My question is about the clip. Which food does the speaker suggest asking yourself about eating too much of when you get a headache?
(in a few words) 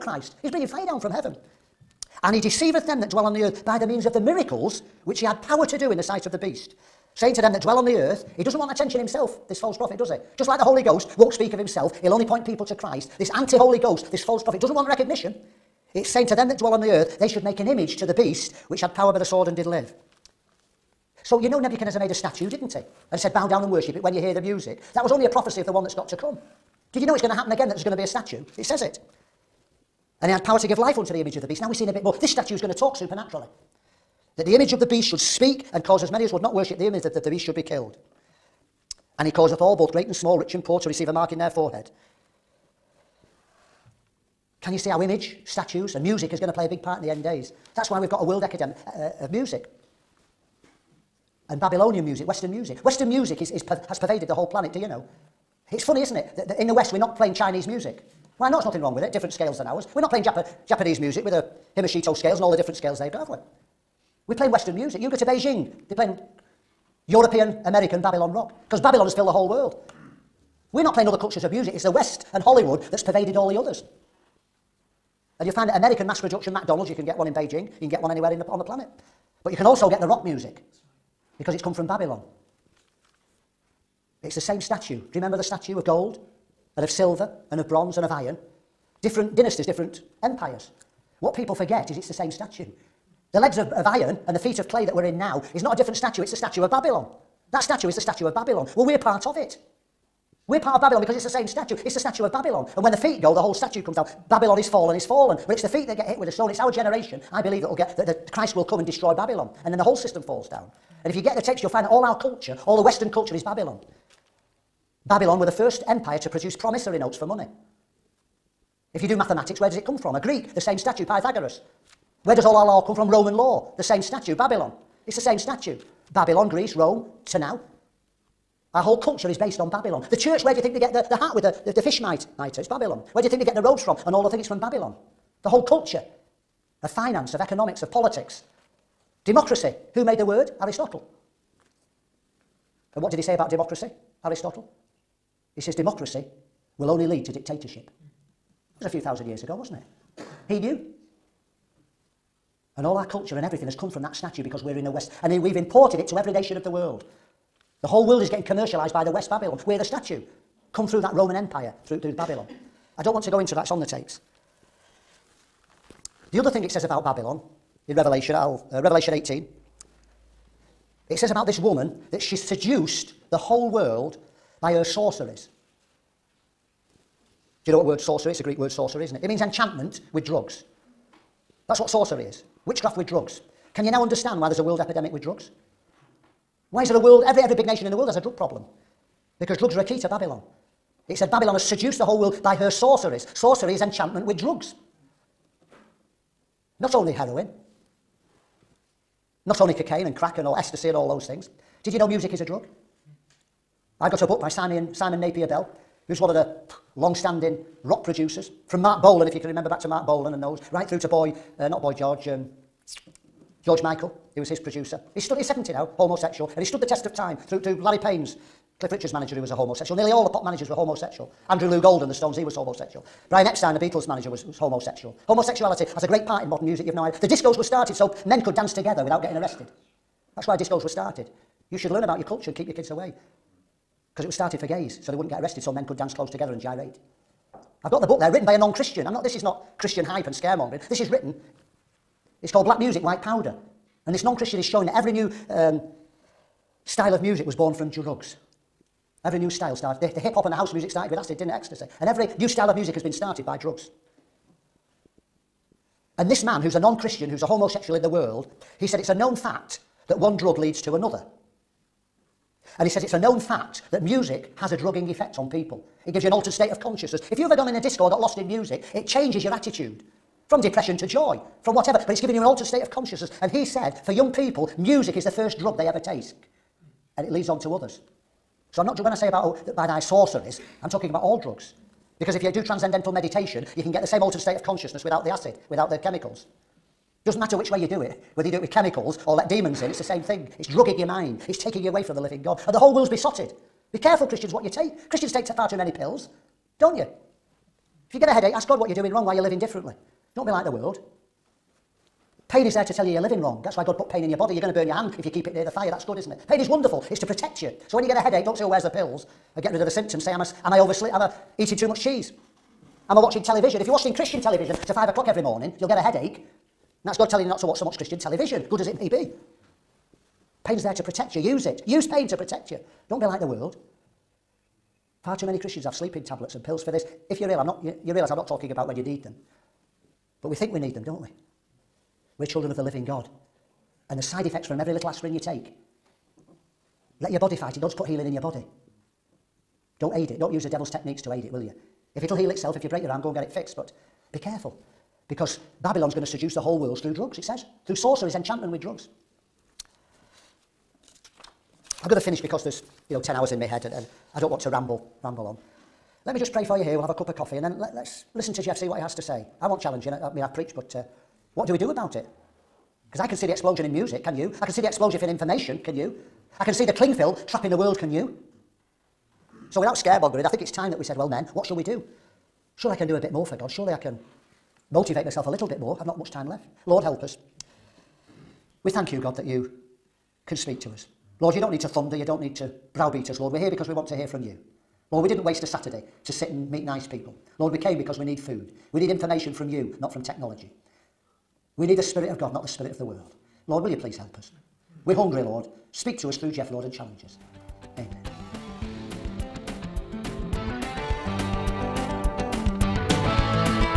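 Cheese.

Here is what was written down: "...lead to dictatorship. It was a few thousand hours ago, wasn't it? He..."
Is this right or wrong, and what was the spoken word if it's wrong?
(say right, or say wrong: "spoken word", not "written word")
wrong: "years", not "hours".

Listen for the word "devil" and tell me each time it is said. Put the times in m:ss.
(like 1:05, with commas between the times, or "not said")
5:40.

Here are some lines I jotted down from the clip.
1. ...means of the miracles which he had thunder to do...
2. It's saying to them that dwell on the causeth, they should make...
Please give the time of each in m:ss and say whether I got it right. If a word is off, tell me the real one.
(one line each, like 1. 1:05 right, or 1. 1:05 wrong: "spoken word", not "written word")
1. 0:03 wrong: "power", not "thunder"
2. 0:15 wrong: "earth", not "causeth".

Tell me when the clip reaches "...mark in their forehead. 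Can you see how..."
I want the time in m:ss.
0:41.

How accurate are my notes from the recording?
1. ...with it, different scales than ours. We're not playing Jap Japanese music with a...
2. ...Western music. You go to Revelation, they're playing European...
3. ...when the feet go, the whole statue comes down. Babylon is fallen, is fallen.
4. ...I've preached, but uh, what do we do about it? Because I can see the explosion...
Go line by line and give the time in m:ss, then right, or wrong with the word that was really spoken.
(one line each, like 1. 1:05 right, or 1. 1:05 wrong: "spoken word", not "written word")
1. 0:58 right
2. 1:04 wrong: "Beijing", not "Revelation"
3. 1:42 right
4. 6:00 right.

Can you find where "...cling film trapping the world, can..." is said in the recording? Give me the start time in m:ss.
6:06.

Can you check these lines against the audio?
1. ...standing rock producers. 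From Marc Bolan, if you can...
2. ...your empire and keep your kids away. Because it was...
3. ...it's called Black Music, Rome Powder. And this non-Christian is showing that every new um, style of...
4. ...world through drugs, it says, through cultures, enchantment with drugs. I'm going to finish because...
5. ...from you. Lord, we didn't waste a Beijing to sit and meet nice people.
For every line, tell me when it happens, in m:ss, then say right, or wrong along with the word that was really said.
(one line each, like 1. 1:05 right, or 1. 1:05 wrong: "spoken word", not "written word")
1. 3:27 right
2. 3:52 wrong: "culture", not "empire"
3. 4:02 wrong: "White", not "Rome"
4. 5:46 wrong: "sorceries", not "cultures"
5. 6:24 wrong: "Saturday", not "Beijing".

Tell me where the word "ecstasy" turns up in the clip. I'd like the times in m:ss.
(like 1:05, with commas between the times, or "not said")
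3:20, 4:11.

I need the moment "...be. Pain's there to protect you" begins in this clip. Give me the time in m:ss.
5:19.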